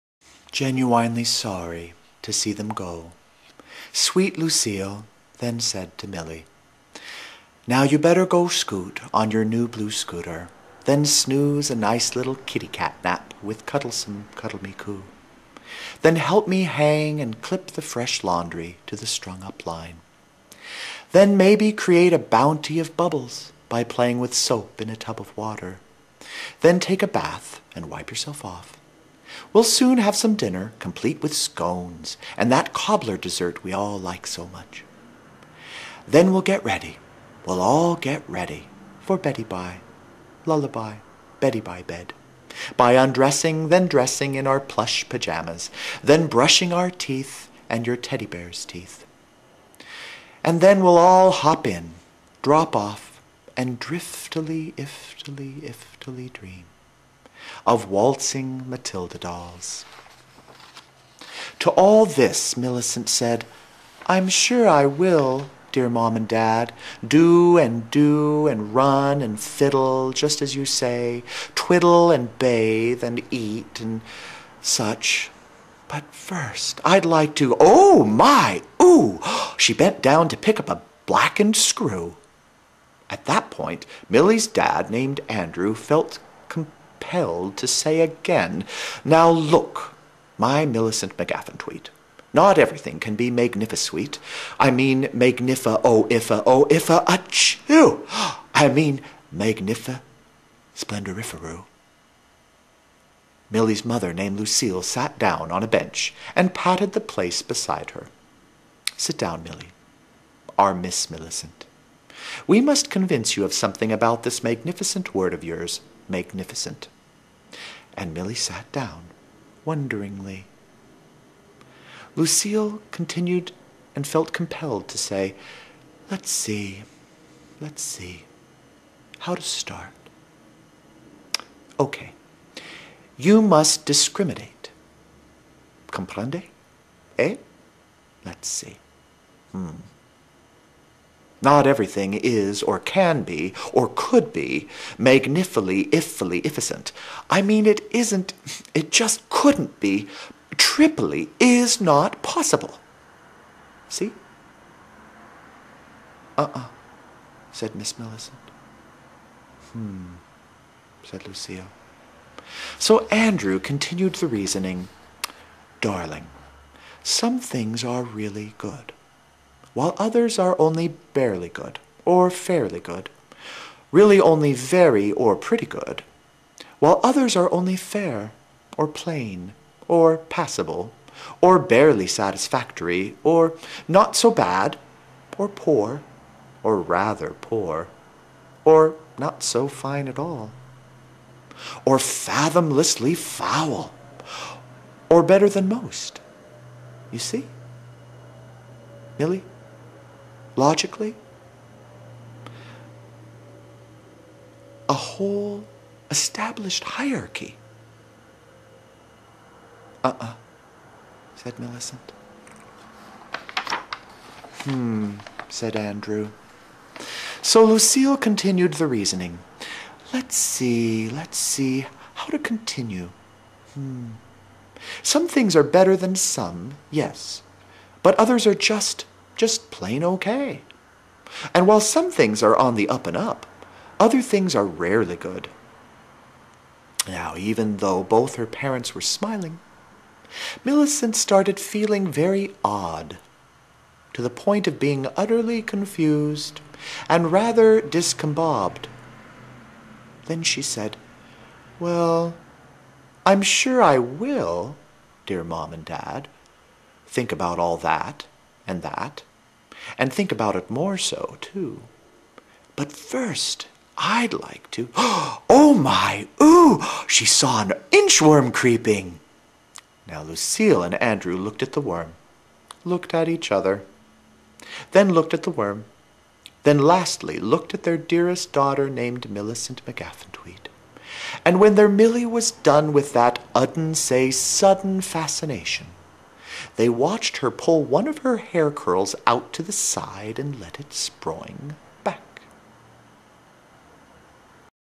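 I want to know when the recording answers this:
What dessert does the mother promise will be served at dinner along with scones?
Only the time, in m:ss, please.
0:32.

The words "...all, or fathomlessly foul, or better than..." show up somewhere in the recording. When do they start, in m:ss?
3:10.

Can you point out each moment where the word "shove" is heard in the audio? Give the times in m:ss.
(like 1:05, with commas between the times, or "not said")
not said.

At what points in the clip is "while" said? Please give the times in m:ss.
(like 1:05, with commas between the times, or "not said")
2:49, 2:56, 3:51.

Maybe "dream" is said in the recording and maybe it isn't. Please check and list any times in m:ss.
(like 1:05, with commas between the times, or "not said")
0:56.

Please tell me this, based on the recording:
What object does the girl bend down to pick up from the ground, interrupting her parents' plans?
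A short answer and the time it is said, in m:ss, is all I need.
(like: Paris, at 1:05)
a blackened screw, at 1:21.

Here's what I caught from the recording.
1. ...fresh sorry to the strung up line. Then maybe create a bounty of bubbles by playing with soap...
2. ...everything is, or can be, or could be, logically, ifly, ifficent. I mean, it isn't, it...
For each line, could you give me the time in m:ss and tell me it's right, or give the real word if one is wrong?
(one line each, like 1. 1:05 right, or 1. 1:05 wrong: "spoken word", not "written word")
1. 0:17 wrong: "laundry", not "sorry"
2. 2:21 wrong: "magnifically", not "logically".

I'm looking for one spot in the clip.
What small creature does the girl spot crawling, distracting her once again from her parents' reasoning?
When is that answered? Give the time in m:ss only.
4:27.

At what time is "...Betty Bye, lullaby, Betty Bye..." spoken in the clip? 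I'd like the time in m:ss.
0:39.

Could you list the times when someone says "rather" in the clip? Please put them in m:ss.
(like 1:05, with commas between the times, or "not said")
3:06, 4:07.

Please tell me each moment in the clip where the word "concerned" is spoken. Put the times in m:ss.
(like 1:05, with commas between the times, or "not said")
not said.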